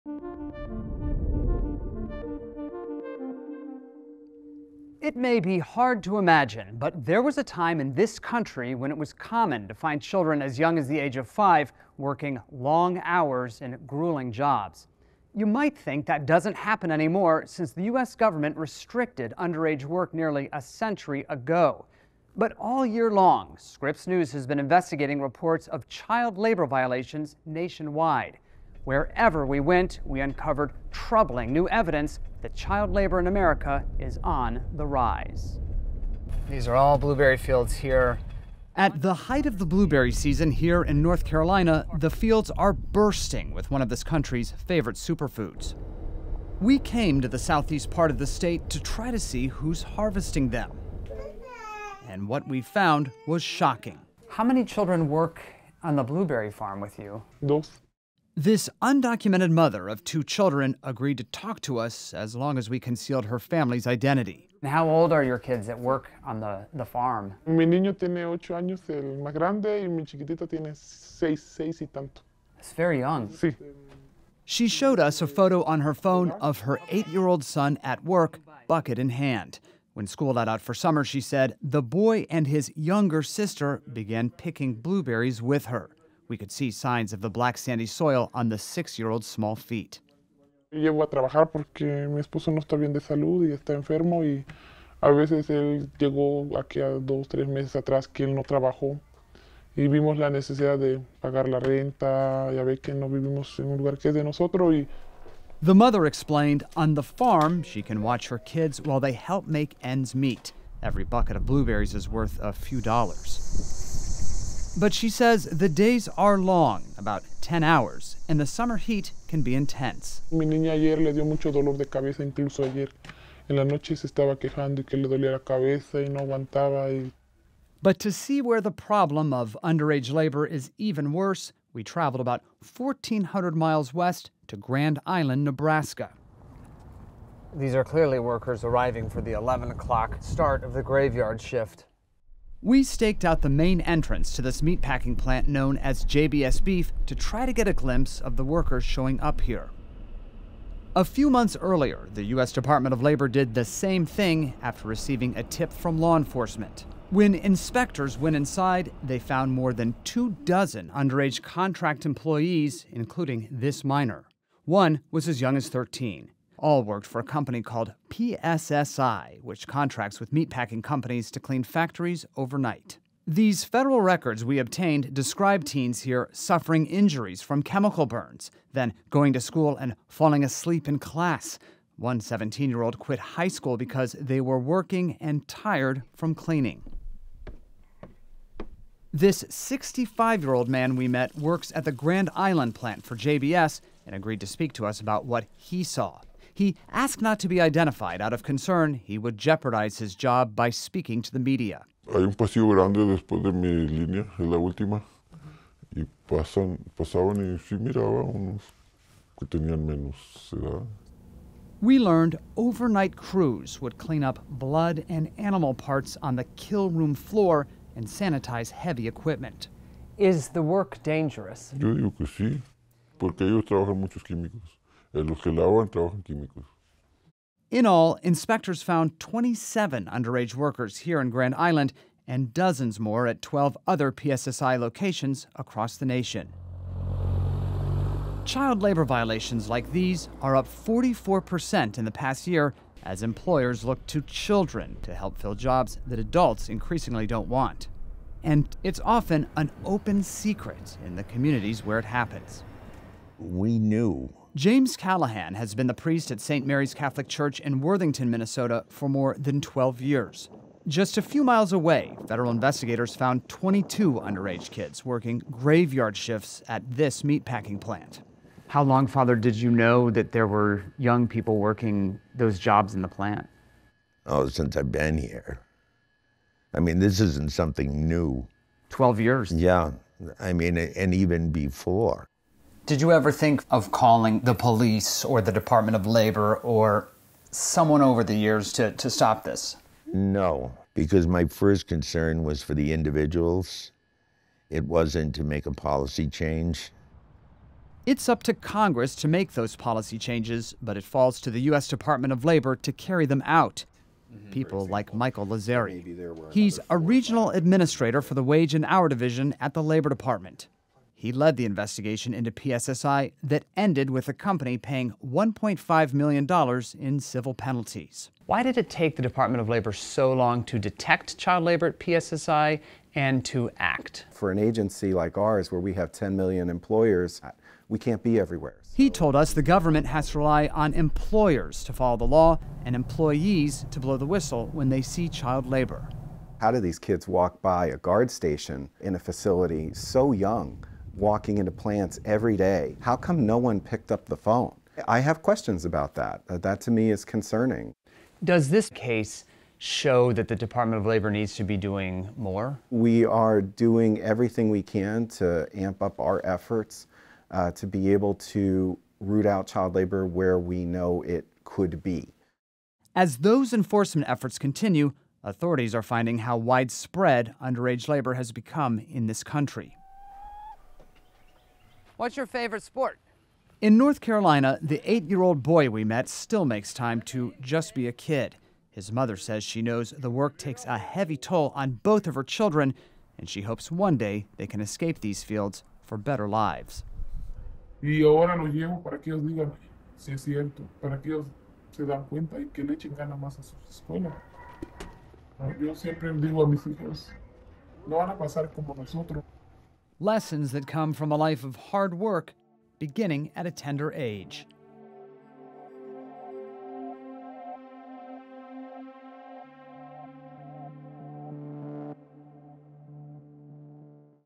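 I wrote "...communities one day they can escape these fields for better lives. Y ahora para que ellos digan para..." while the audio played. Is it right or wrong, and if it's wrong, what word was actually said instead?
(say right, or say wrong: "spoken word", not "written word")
wrong: "hopes", not "communities".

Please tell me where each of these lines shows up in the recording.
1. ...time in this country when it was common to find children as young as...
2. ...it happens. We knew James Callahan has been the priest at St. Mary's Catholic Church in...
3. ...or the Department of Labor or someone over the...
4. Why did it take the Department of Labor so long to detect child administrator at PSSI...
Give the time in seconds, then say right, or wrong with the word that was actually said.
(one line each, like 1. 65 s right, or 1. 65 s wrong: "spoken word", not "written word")
1. 7 s right
2. 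251 s right
3. 285 s right
4. 318 s wrong: "labor", not "administrator".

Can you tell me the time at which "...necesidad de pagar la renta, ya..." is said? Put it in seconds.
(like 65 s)
100 s.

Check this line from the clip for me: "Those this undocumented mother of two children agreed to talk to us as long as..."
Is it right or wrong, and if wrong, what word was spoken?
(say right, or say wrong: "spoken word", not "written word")
right.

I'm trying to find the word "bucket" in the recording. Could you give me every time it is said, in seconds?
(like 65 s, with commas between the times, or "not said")
78 s, 111 s.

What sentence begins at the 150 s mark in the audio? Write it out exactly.
A few months earlier, the U.S.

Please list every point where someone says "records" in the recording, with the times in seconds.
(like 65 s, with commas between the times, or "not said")
174 s.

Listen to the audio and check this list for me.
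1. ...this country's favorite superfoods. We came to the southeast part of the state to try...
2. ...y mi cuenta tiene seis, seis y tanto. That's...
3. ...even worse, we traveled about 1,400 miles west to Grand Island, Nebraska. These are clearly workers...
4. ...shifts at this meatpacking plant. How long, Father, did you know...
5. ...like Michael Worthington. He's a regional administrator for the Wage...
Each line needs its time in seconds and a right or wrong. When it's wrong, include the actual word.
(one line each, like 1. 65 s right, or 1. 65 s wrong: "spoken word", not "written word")
1. 43 s right
2. 69 s wrong: "chiquitita", not "cuenta"
3. 130 s right
4. 266 s right
5. 304 s wrong: "Lazzeri", not "Worthington".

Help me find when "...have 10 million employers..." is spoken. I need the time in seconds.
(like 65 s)
325 s.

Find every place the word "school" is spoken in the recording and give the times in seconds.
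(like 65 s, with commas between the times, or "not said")
80 s, 179 s, 183 s.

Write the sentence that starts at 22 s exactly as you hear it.
But all year long, Scripps News has been investigating reports of child labor violations nationwide.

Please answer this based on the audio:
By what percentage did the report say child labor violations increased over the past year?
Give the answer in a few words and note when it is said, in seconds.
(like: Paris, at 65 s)
44%, at 240 s.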